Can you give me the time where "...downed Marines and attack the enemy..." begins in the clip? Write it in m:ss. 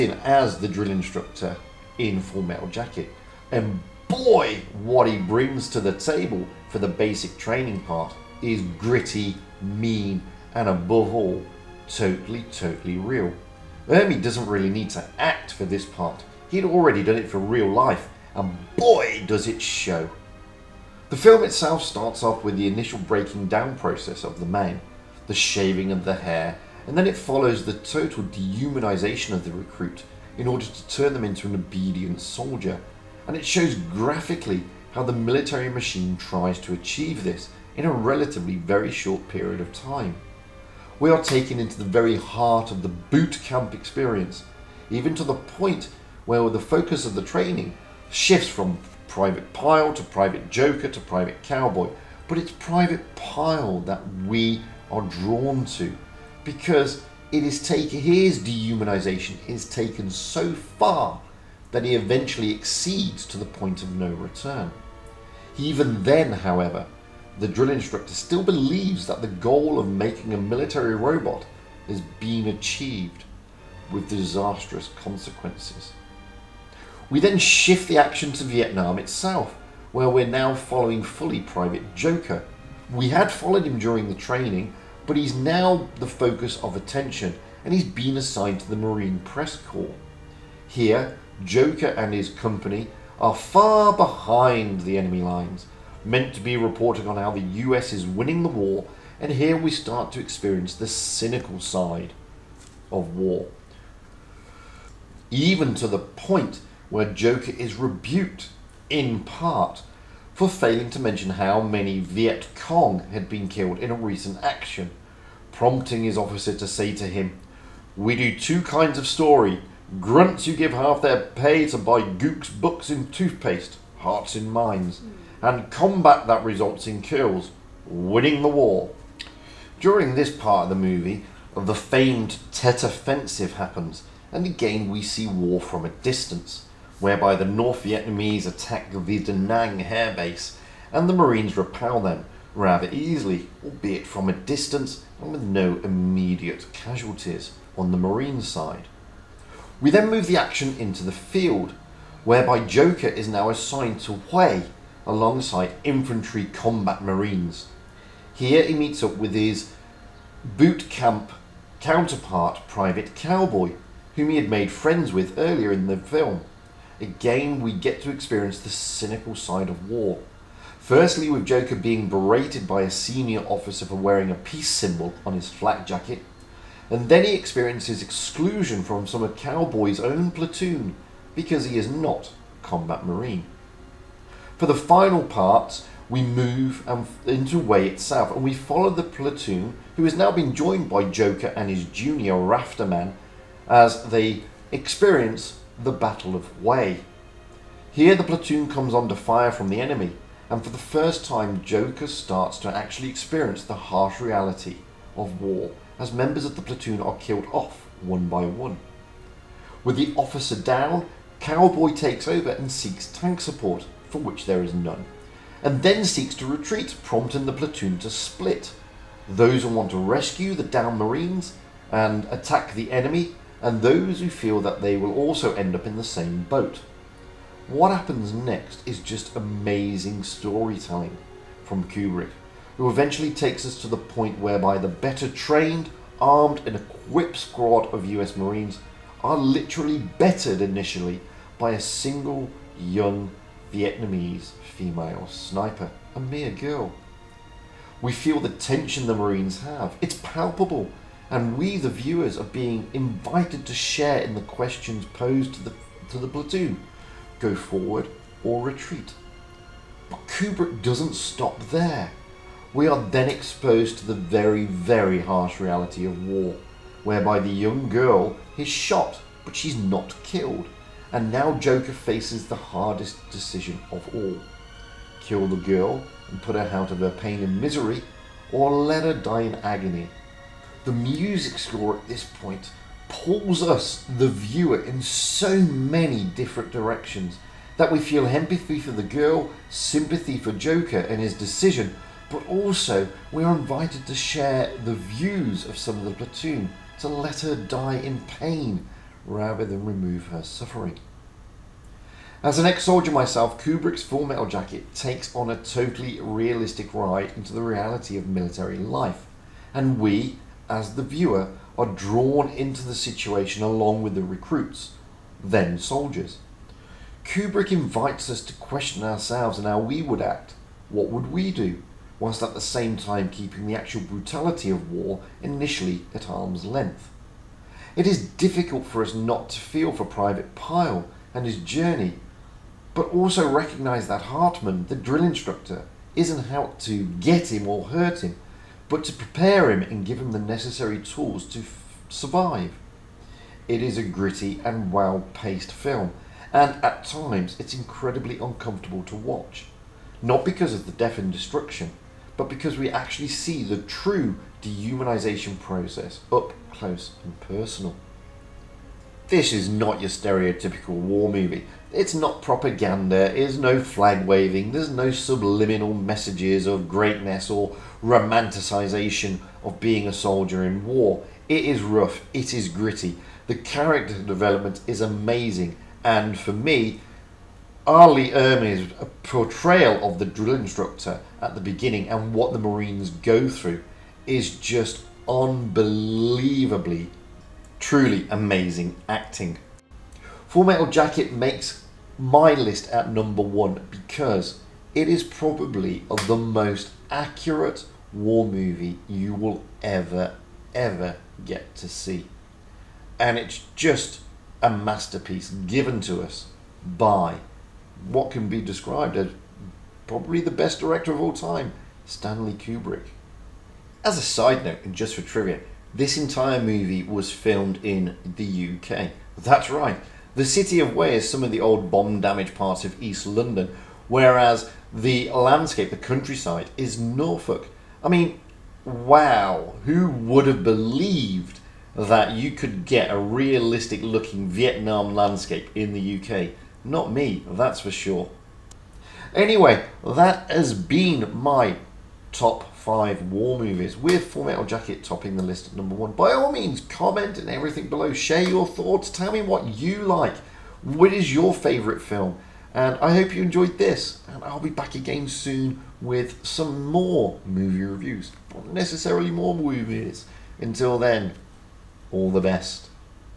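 3:40.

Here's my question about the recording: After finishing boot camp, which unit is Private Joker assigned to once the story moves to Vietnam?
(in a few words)
Marine Press Corps.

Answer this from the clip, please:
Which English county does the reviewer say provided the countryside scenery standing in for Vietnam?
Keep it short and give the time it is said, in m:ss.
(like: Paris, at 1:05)
Norfolk, at 7:06.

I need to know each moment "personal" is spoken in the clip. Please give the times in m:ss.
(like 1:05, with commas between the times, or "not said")
5:57.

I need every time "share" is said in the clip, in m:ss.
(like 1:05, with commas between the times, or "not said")
4:13, 4:54, 7:28.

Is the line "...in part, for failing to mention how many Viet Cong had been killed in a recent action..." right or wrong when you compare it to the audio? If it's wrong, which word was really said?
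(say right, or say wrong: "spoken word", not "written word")
right.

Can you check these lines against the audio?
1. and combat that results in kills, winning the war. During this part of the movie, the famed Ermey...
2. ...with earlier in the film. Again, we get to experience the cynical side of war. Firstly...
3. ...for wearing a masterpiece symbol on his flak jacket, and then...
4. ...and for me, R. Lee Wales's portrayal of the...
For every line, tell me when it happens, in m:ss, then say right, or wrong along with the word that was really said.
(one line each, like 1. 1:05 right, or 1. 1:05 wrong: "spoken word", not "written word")
1. 2:05 wrong: "Tet", not "Ermey"
2. 2:45 right
3. 2:53 wrong: "peace", not "masterpiece"
4. 6:16 wrong: "Ermey", not "Wales".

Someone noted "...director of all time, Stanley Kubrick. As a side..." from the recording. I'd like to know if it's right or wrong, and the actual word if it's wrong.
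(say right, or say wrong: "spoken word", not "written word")
right.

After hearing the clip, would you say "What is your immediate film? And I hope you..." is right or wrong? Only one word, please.
wrong.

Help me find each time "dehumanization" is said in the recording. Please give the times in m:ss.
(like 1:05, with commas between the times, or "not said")
0:28, 0:58, 5:54.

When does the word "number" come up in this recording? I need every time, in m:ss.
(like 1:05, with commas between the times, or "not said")
6:33, 7:25.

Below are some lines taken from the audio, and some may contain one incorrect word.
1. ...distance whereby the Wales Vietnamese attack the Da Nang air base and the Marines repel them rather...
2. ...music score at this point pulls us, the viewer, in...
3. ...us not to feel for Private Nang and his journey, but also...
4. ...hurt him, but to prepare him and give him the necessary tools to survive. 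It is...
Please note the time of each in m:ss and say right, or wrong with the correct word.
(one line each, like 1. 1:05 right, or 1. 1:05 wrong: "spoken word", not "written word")
1. 2:15 wrong: "North", not "Wales"
2. 4:40 right
3. 5:29 wrong: "Pyle", not "Nang"
4. 5:37 right.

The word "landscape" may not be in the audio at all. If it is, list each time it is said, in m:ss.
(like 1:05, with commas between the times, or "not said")
7:05, 7:15.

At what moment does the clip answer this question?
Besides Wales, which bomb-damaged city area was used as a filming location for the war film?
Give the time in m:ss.
7:03.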